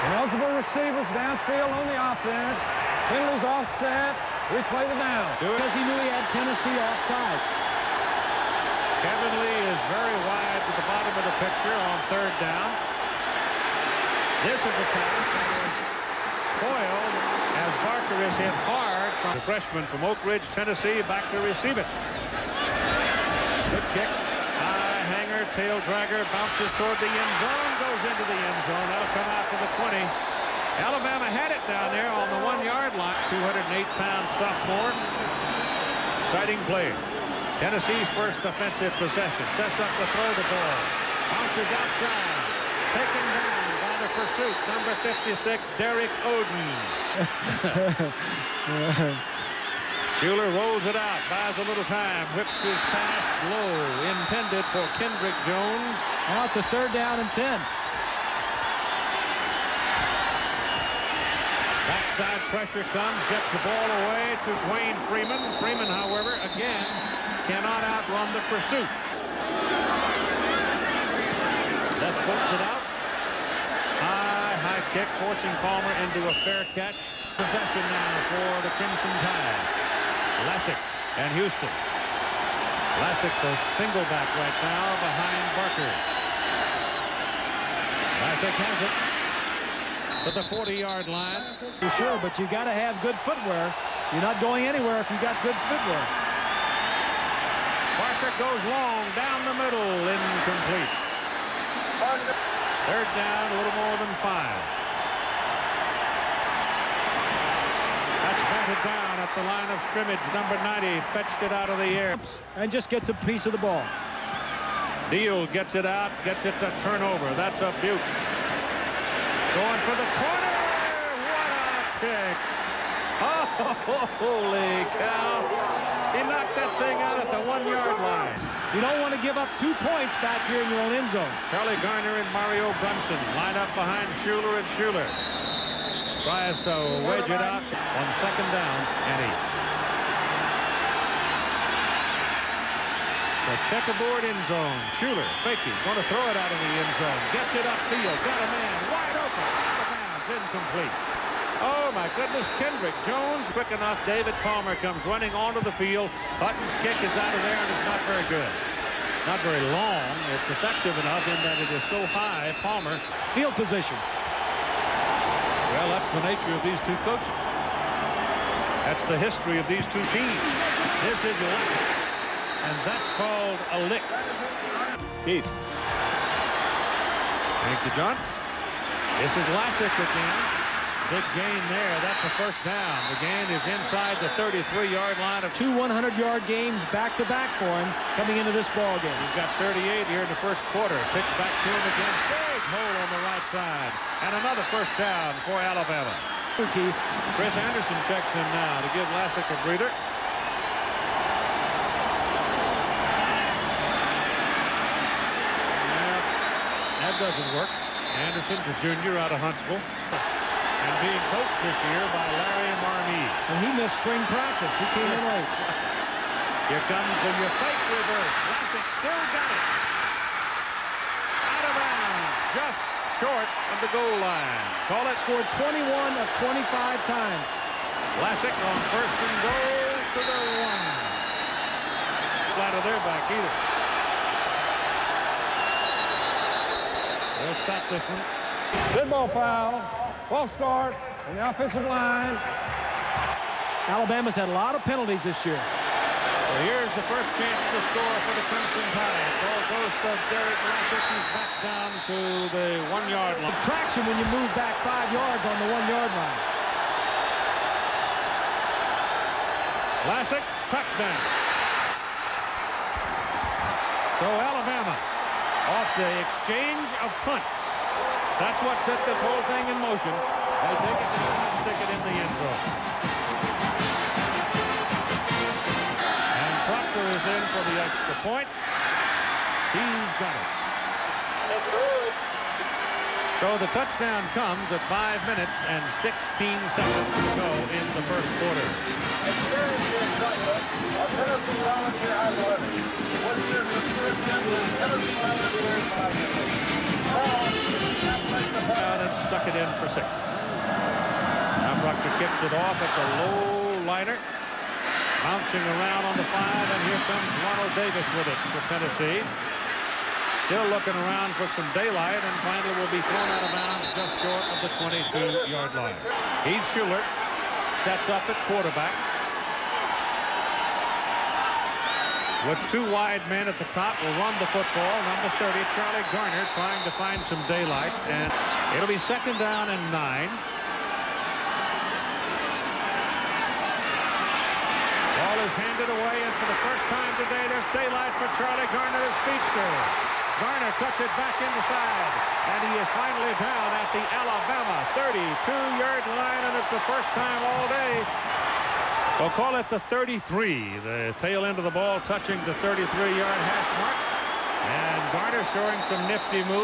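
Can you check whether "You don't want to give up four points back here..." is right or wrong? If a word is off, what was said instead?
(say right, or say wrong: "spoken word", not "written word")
wrong: "two", not "four".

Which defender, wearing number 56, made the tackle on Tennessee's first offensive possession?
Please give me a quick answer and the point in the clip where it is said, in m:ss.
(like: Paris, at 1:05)
Derek Oden, at 0:45.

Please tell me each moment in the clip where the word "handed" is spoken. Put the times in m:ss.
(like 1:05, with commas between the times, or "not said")
5:35.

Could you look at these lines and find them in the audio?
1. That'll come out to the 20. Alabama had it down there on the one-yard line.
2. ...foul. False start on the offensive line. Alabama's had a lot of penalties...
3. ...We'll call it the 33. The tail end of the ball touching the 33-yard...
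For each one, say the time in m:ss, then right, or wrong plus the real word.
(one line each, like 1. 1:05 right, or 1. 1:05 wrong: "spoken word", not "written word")
1. 0:28 right
2. 3:59 right
3. 5:49 right.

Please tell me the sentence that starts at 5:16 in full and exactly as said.
Heath Shuler sets up at quarterback.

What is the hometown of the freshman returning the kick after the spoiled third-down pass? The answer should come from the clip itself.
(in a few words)
Oak Ridge, Tennessee.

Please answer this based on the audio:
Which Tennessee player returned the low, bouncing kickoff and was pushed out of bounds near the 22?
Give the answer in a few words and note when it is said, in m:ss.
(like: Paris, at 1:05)
Ronald Davis, at 5:07.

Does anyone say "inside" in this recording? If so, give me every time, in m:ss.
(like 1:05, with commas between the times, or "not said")
3:03, 5:41.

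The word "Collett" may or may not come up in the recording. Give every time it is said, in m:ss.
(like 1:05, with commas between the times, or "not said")
3:44.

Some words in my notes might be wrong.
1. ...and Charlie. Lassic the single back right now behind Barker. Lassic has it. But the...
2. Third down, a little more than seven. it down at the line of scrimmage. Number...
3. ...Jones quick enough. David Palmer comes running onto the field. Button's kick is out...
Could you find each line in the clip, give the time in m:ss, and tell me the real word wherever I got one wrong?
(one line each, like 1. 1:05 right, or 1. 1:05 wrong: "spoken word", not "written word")
1. 1:21 wrong: "Houston", not "Charlie"
2. 1:42 wrong: "five", not "seven"
3. 2:33 right.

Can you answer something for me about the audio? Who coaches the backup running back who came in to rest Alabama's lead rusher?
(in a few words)
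Larry Marmie.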